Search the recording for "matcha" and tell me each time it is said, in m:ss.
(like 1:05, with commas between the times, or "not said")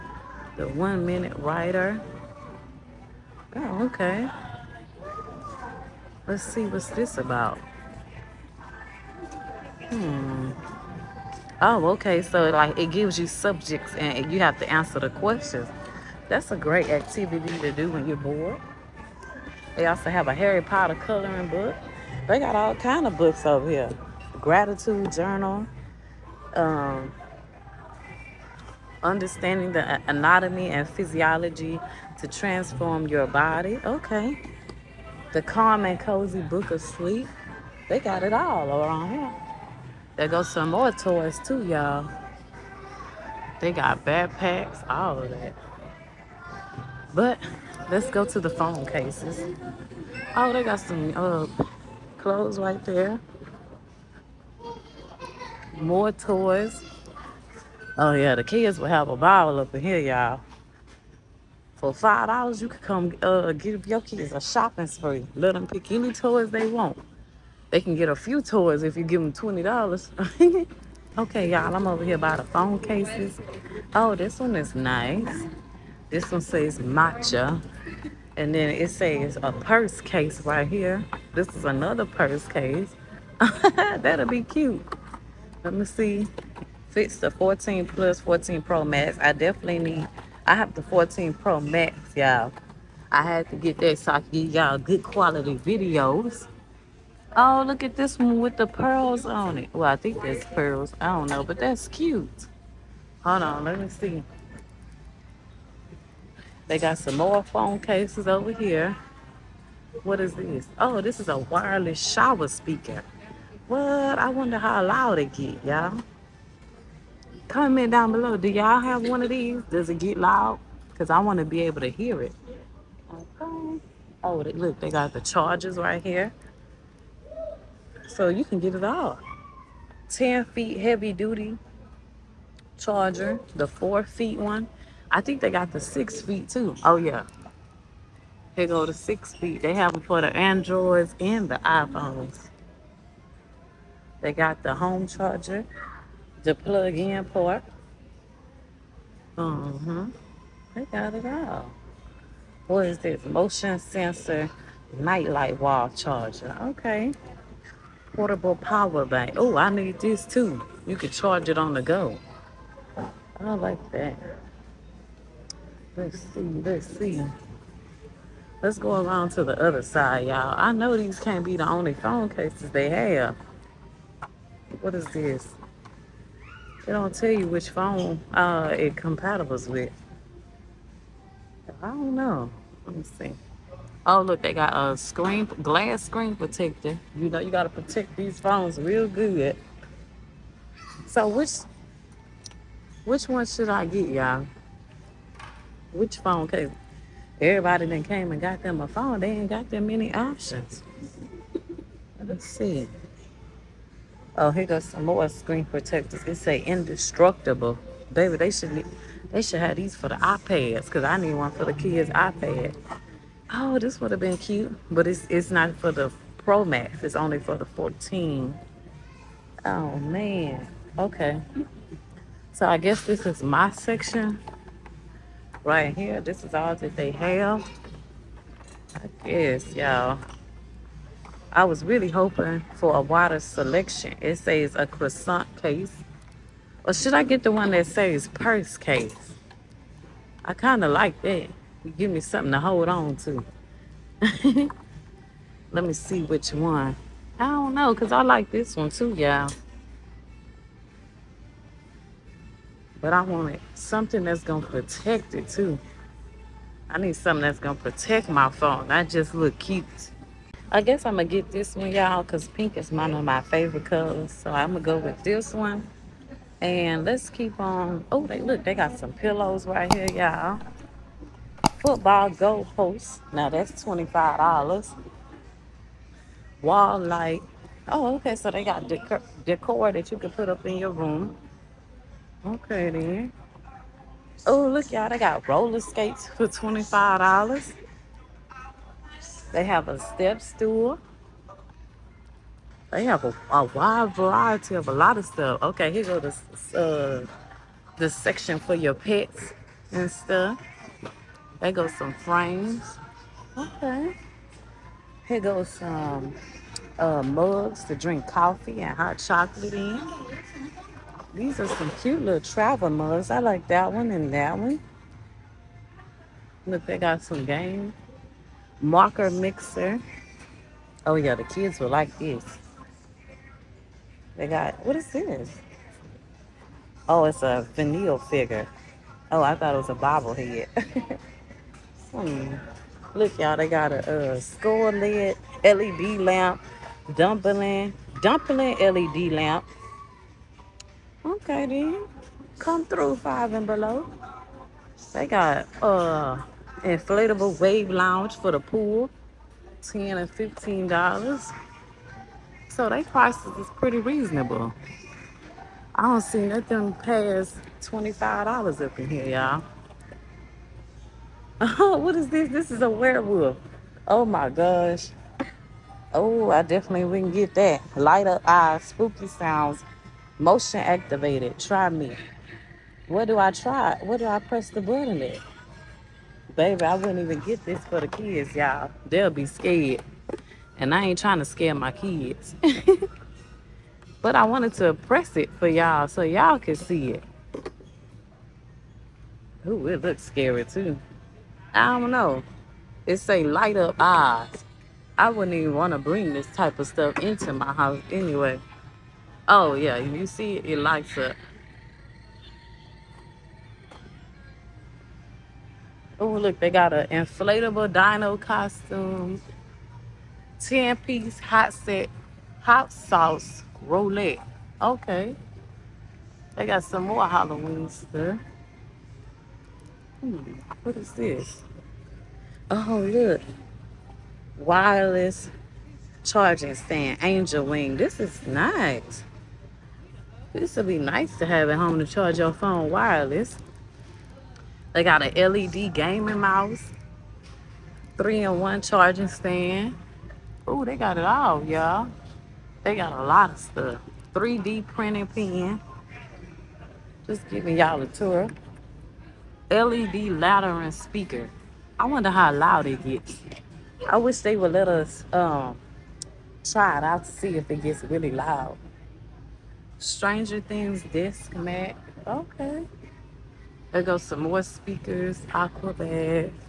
1:16.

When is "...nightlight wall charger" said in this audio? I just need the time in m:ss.
2:34.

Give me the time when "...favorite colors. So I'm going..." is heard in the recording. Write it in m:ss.
4:23.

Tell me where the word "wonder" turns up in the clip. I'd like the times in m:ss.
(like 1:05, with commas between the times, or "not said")
1:54, 7:32.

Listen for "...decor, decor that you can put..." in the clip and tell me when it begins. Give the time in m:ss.
4:38.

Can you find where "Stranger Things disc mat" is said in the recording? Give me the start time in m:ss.
7:39.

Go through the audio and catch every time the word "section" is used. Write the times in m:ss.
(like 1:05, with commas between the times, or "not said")
3:43, 4:58.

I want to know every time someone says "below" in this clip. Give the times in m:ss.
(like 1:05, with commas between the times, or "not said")
1:58, 5:43.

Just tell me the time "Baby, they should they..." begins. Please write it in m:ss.
3:28.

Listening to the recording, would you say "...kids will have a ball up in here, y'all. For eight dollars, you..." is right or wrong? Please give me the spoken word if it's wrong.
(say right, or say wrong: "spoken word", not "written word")
wrong: "five", not "eight".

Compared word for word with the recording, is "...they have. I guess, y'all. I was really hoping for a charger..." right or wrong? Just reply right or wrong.
wrong.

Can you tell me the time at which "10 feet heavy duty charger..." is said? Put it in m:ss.
2:10.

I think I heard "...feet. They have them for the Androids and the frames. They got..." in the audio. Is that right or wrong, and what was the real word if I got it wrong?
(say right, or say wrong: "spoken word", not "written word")
wrong: "iPhones", not "frames".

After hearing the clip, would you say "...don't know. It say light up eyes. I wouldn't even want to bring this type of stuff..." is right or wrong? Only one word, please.
right.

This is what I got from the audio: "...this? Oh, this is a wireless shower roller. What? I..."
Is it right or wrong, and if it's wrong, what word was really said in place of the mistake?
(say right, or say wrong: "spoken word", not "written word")
wrong: "speaker", not "roller".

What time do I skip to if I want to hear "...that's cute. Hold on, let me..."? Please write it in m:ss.
1:41.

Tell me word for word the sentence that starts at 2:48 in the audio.
Let's go around to the other side, y'all.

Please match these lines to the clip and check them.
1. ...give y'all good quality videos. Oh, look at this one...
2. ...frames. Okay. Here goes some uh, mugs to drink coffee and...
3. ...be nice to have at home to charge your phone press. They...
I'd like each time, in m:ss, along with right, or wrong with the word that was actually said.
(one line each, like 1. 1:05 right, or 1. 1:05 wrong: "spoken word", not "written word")
1. 1:34 right
2. 5:02 right
3. 7:10 wrong: "wireless", not "press".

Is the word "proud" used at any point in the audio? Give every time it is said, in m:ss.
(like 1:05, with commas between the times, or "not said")
not said.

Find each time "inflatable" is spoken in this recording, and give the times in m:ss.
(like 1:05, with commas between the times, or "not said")
5:46, 6:47.